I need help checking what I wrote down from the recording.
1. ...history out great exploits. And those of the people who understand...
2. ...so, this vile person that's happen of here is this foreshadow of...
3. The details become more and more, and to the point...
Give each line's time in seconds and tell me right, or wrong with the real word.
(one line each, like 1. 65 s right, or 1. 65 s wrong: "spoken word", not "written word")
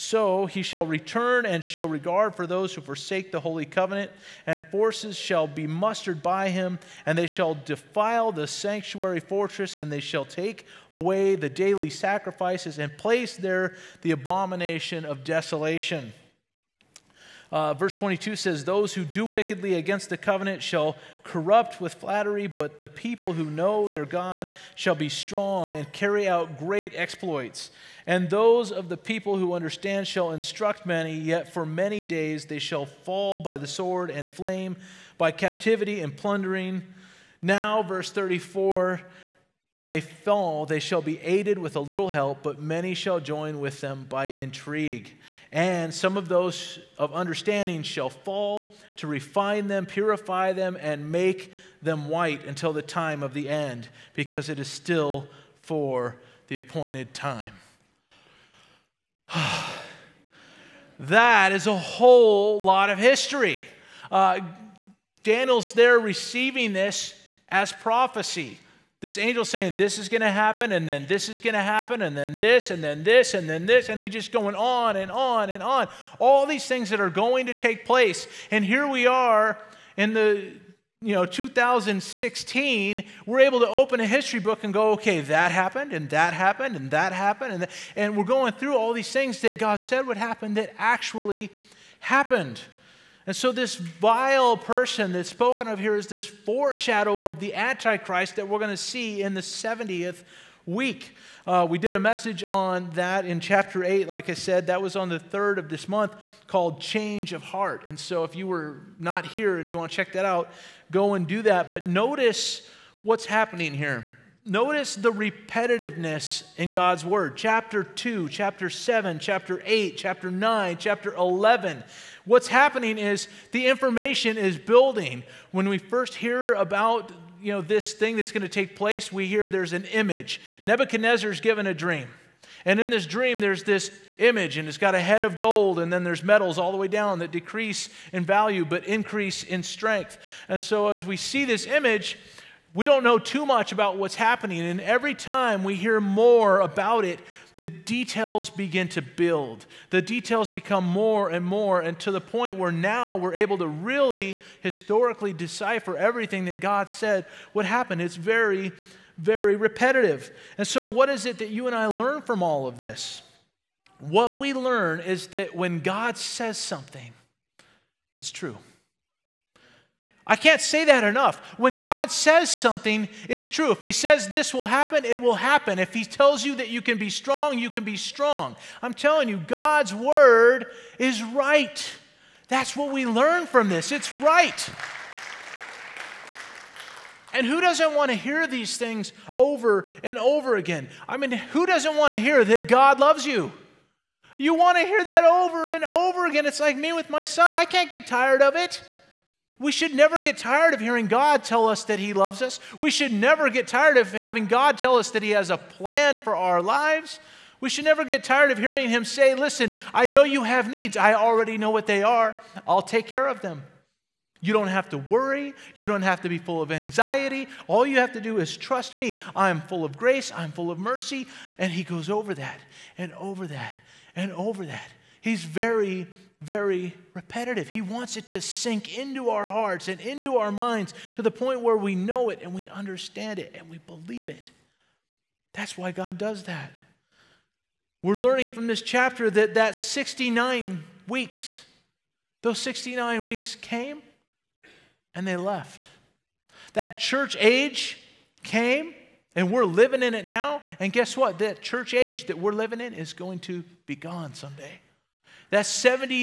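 1. 25 s wrong: "carry", not "history"
2. 93 s wrong: "spoken", not "happen"
3. 149 s right.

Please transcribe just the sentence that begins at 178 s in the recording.
I'm telling you, God's word is right.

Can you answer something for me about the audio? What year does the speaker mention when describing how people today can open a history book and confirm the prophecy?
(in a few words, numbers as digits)
2016.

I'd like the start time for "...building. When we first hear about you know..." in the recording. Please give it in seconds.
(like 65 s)
124 s.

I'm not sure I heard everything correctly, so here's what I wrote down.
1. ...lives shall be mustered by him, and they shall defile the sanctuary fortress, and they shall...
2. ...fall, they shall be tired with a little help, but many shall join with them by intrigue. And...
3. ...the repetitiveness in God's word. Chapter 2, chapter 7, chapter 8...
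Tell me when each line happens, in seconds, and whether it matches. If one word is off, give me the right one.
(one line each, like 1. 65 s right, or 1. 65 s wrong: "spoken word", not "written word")
1. 4 s wrong: "forces", not "lives"
2. 40 s wrong: "aided", not "tired"
3. 114 s right.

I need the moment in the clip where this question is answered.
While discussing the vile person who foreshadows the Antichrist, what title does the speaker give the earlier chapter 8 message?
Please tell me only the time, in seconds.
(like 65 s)
106 s.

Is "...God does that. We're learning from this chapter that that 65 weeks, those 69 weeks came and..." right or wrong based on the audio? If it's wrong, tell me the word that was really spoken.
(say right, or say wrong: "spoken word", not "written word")
wrong: "69", not "65".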